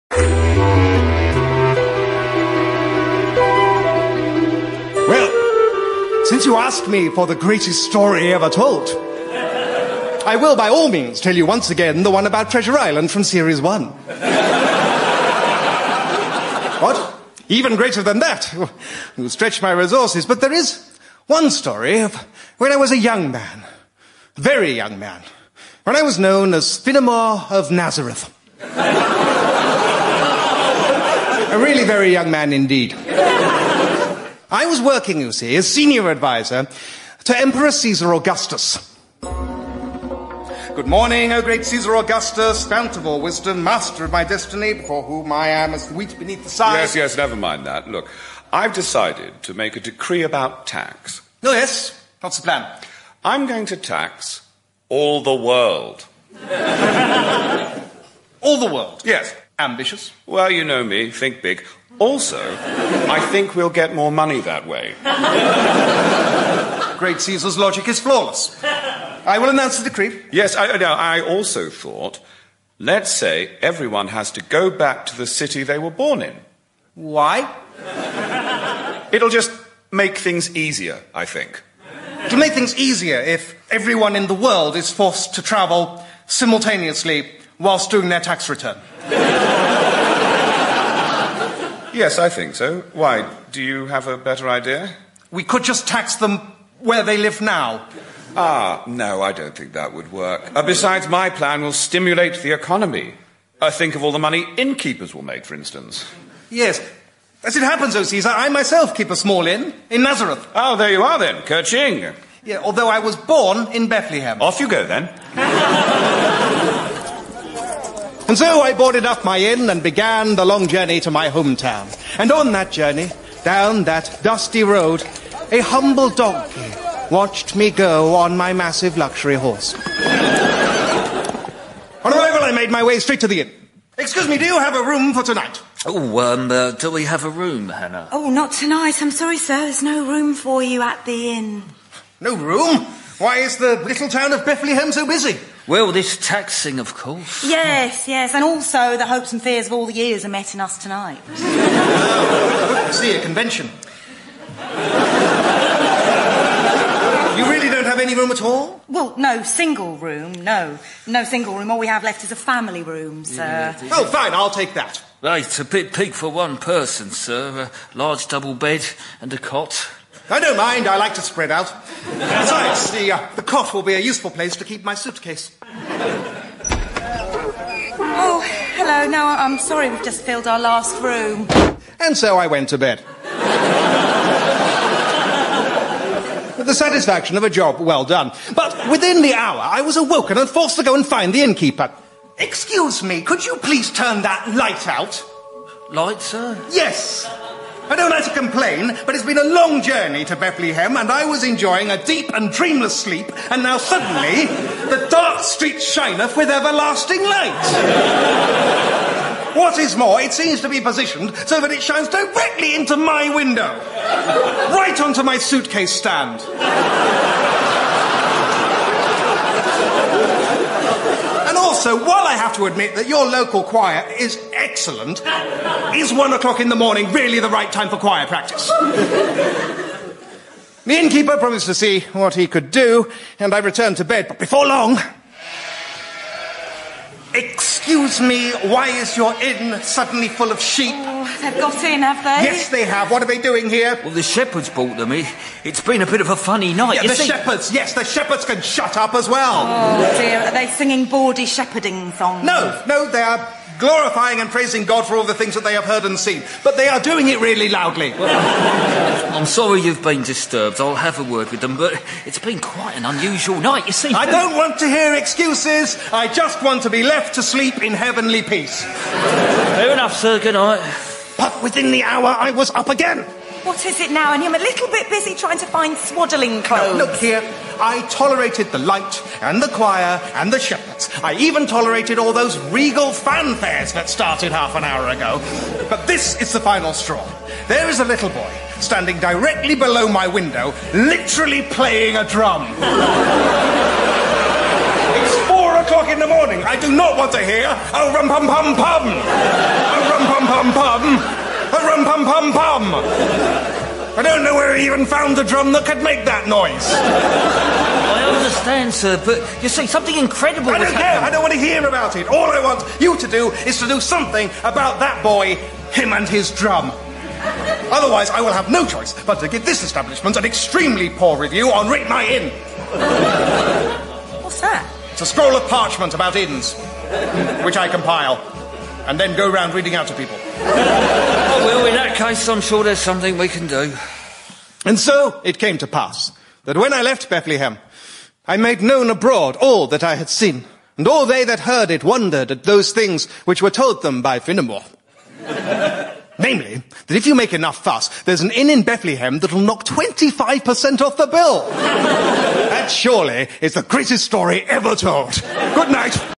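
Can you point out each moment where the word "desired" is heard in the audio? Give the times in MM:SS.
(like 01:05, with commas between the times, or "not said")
not said.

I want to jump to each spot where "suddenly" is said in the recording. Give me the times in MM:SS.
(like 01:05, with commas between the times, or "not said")
03:23, 03:59.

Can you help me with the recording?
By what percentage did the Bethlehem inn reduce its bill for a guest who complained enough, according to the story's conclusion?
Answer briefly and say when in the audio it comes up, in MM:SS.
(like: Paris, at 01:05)
25%, at 05:49.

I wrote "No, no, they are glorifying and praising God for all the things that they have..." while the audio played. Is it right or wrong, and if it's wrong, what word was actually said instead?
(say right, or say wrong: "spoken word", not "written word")
right.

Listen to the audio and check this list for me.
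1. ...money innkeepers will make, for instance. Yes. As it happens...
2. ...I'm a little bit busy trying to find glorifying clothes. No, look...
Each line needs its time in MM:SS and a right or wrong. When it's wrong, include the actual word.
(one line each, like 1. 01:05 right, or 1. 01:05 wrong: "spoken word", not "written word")
1. 01:44 right
2. 04:34 wrong: "swaddling", not "glorifying".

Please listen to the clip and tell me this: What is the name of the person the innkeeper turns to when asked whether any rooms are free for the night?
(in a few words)
Hannah.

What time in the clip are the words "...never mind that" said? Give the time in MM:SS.
00:47.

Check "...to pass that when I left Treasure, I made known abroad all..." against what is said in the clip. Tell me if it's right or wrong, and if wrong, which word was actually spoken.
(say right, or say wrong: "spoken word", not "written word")
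wrong: "Bethlehem", not "Treasure".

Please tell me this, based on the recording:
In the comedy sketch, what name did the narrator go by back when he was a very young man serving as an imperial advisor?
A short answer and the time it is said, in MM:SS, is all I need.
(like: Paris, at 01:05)
Finnemore of Nazareth, at 00:26.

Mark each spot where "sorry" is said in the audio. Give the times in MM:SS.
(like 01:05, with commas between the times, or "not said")
02:19, 02:59, 04:19.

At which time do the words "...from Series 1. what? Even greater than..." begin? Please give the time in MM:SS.
00:13.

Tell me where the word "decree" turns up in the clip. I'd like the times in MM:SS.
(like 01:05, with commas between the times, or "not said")
00:49, 01:09.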